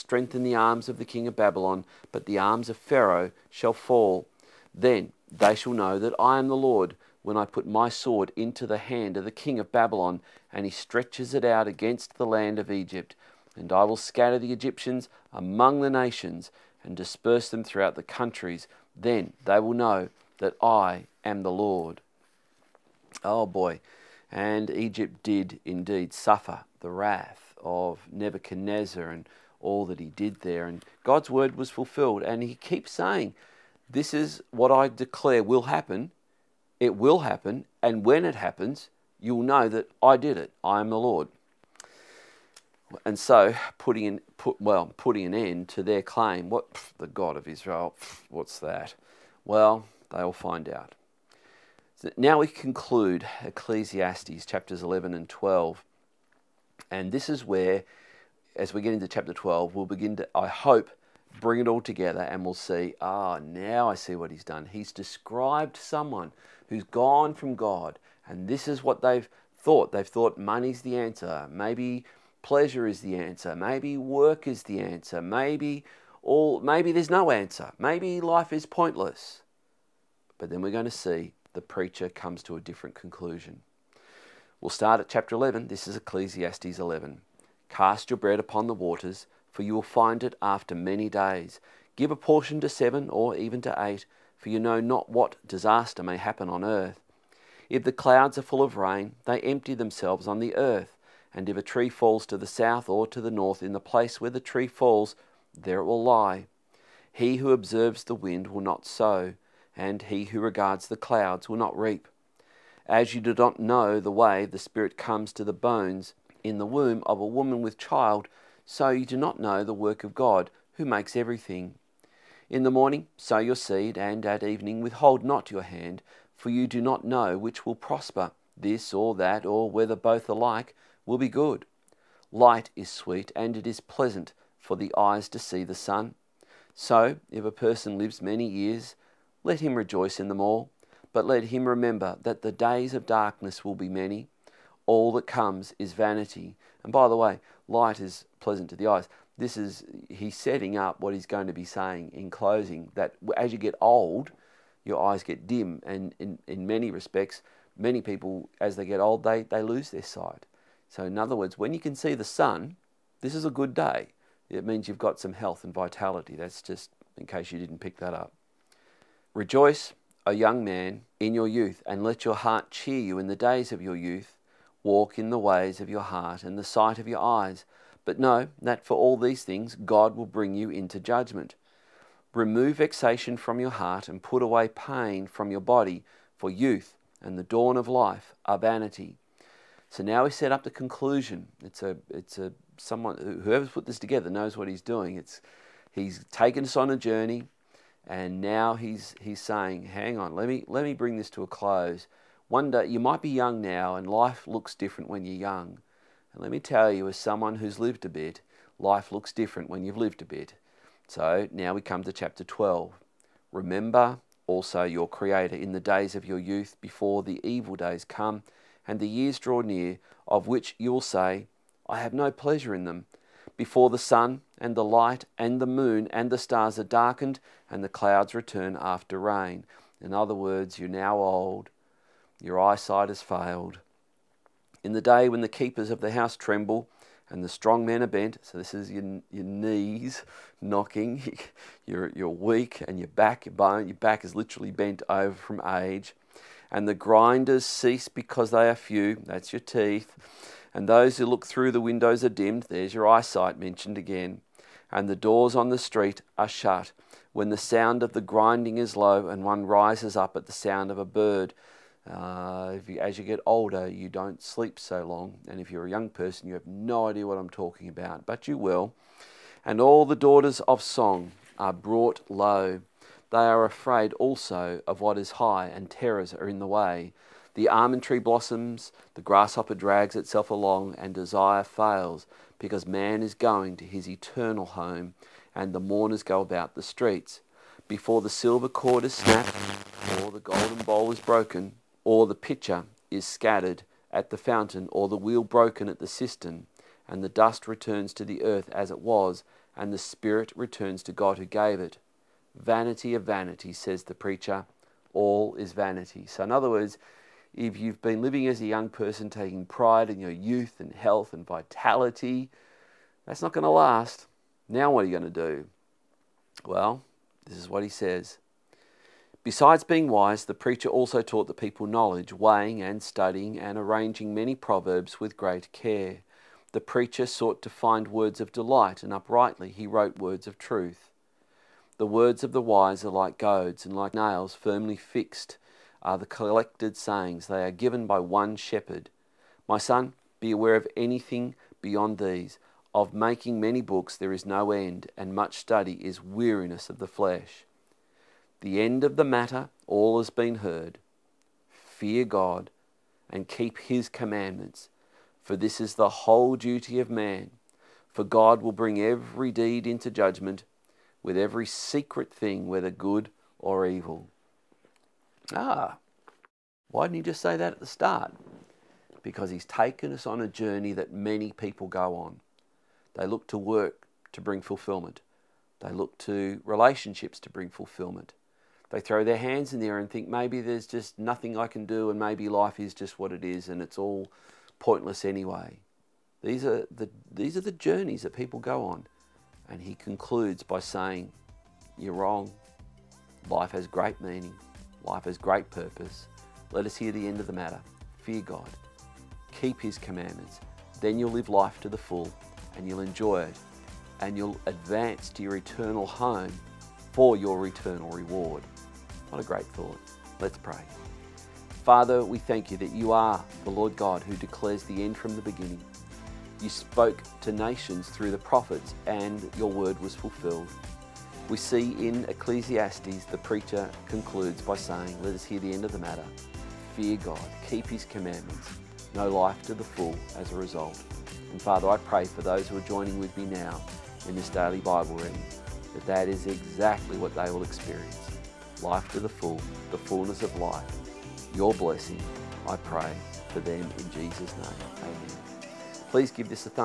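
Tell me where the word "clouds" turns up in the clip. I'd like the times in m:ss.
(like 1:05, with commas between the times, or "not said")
1:37, 1:50, 3:47.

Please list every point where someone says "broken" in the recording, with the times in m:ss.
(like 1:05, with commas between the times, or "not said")
4:51, 4:55.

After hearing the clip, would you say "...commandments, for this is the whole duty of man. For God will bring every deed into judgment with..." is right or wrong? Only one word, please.
right.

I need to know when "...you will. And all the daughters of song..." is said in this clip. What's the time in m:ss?
4:28.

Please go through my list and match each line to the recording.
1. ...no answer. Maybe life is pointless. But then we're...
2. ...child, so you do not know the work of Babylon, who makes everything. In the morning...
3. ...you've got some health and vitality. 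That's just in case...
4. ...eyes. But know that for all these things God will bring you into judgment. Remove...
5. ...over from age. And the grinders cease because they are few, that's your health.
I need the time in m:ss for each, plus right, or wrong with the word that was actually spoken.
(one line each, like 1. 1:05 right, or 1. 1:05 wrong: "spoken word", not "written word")
1. 1:17 right
2. 1:57 wrong: "God", not "Babylon"
3. 2:44 right
4. 2:57 right
5. 4:05 wrong: "teeth", not "health".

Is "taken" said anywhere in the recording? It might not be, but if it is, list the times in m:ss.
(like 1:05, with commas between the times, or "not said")
3:16, 6:09.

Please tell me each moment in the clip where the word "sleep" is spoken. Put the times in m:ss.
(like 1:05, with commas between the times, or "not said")
4:24.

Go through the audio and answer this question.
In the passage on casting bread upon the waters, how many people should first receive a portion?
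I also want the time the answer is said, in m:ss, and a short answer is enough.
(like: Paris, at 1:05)
7, at 1:32.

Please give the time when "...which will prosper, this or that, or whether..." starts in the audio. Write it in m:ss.
2:07.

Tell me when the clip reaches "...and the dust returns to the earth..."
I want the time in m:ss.
4:57.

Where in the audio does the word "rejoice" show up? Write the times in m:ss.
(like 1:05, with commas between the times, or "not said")
2:19, 2:49.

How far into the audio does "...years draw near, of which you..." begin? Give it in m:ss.
3:39.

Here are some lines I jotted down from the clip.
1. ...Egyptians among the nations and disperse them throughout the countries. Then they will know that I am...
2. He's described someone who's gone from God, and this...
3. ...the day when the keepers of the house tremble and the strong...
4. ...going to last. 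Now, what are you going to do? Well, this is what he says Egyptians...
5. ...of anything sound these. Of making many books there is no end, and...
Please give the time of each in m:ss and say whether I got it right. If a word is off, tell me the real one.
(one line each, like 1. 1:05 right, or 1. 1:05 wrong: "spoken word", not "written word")
1. 0:14 right
2. 1:04 right
3. 3:54 right
4. 5:13 wrong: "Besides", not "Egyptians"
5. 5:40 wrong: "beyond", not "sound".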